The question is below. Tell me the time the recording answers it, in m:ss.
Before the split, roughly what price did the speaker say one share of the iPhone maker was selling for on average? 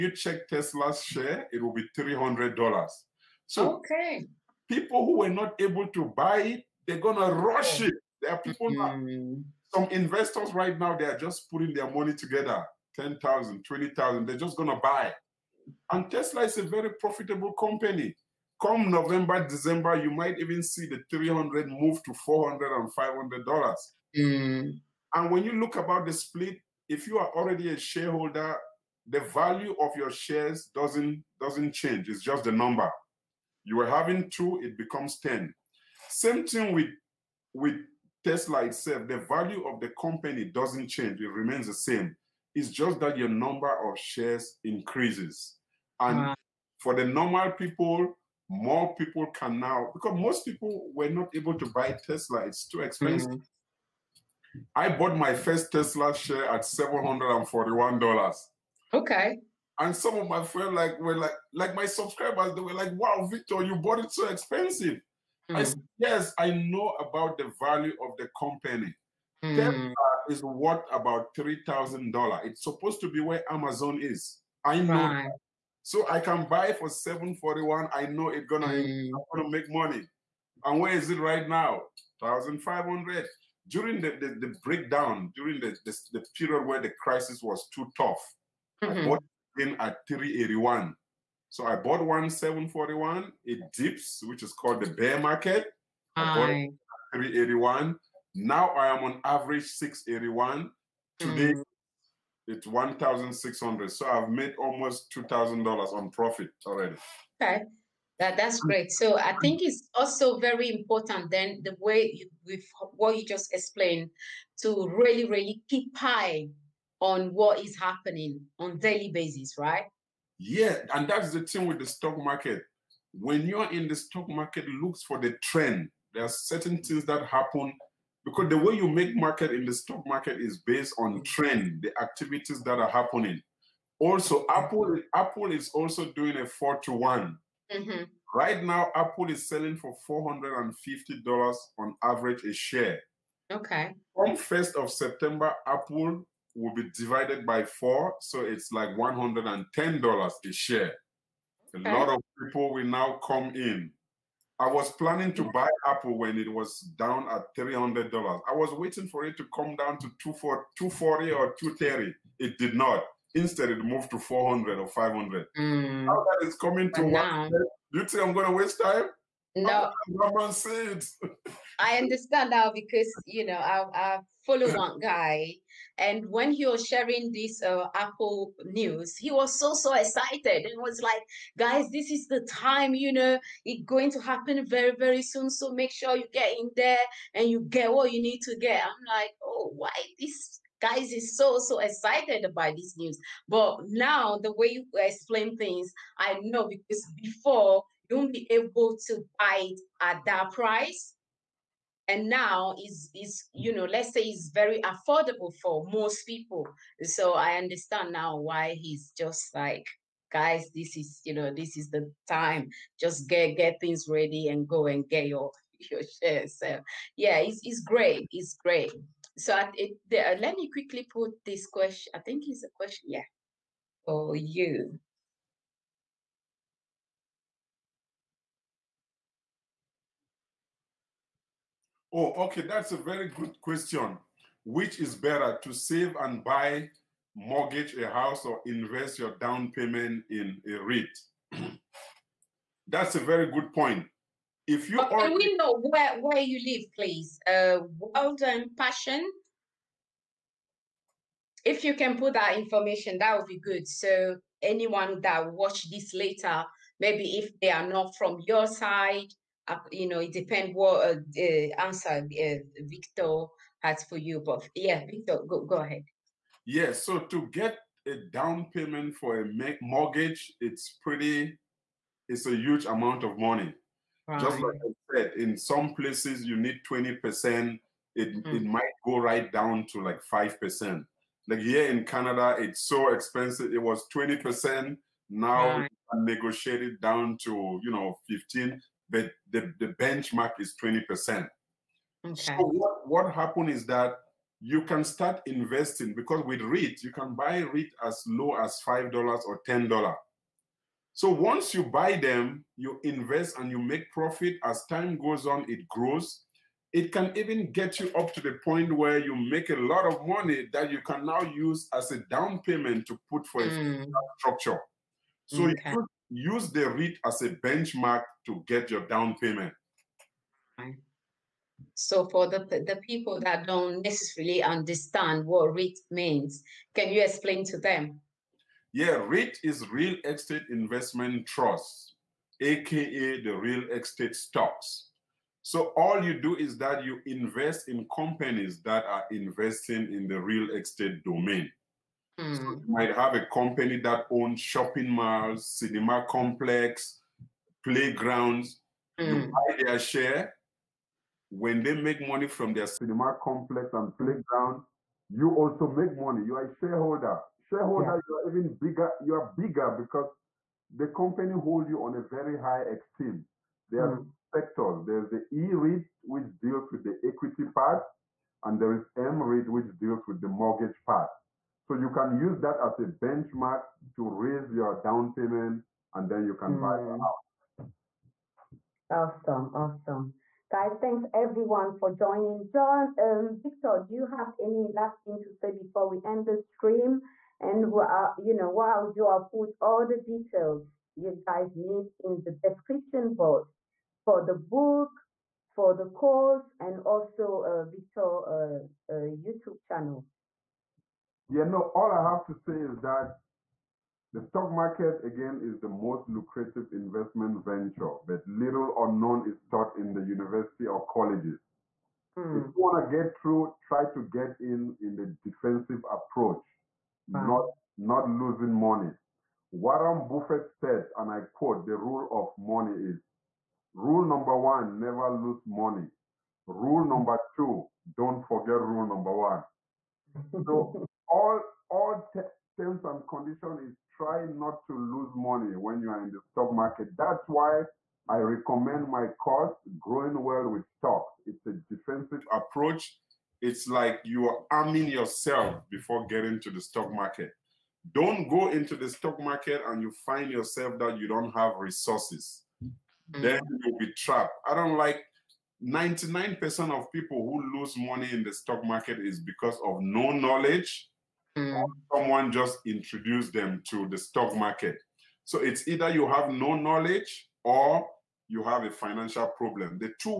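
2:20.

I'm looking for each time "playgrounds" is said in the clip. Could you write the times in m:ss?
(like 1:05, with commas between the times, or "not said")
5:47, 5:54.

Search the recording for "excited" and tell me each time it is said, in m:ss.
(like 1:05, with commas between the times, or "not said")
2:59, 3:11.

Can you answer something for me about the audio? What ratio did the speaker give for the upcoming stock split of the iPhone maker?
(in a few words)
four to one.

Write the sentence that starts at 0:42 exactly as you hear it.
It's just that your number of shares increases.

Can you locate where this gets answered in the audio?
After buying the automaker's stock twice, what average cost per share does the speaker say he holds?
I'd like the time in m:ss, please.
1:39.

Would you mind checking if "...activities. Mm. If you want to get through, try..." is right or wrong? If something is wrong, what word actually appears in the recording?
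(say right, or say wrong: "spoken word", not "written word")
wrong: "colleges", not "activities".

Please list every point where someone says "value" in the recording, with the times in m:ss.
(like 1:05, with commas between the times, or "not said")
0:29, 0:39, 1:07.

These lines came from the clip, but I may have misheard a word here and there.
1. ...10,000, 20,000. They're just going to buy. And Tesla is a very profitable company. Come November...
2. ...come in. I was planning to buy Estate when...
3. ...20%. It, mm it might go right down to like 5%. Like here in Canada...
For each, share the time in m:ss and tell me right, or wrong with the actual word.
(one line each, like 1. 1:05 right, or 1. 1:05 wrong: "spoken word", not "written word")
1. 0:12 right
2. 2:33 wrong: "Apple", not "Estate"
3. 4:36 right.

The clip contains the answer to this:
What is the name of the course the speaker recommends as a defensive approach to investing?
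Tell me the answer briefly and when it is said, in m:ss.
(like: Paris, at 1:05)
Growing Wealth with Stocks, at 7:19.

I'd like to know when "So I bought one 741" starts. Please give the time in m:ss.
1:31.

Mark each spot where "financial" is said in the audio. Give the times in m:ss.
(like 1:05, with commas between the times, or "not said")
7:48.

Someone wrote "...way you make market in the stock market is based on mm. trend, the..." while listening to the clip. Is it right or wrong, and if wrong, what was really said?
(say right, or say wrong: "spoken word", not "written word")
right.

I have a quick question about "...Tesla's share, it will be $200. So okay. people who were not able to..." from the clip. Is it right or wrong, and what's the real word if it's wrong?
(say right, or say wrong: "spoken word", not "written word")
wrong: "300", not "200".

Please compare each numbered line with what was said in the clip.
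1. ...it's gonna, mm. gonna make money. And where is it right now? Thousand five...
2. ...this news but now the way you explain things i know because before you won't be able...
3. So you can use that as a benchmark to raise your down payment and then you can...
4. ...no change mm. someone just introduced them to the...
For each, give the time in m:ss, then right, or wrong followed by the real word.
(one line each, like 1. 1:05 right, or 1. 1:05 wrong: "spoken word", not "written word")
1. 1:18 right
2. 3:12 right
3. 6:11 right
4. 7:39 wrong: "knowledge", not "change".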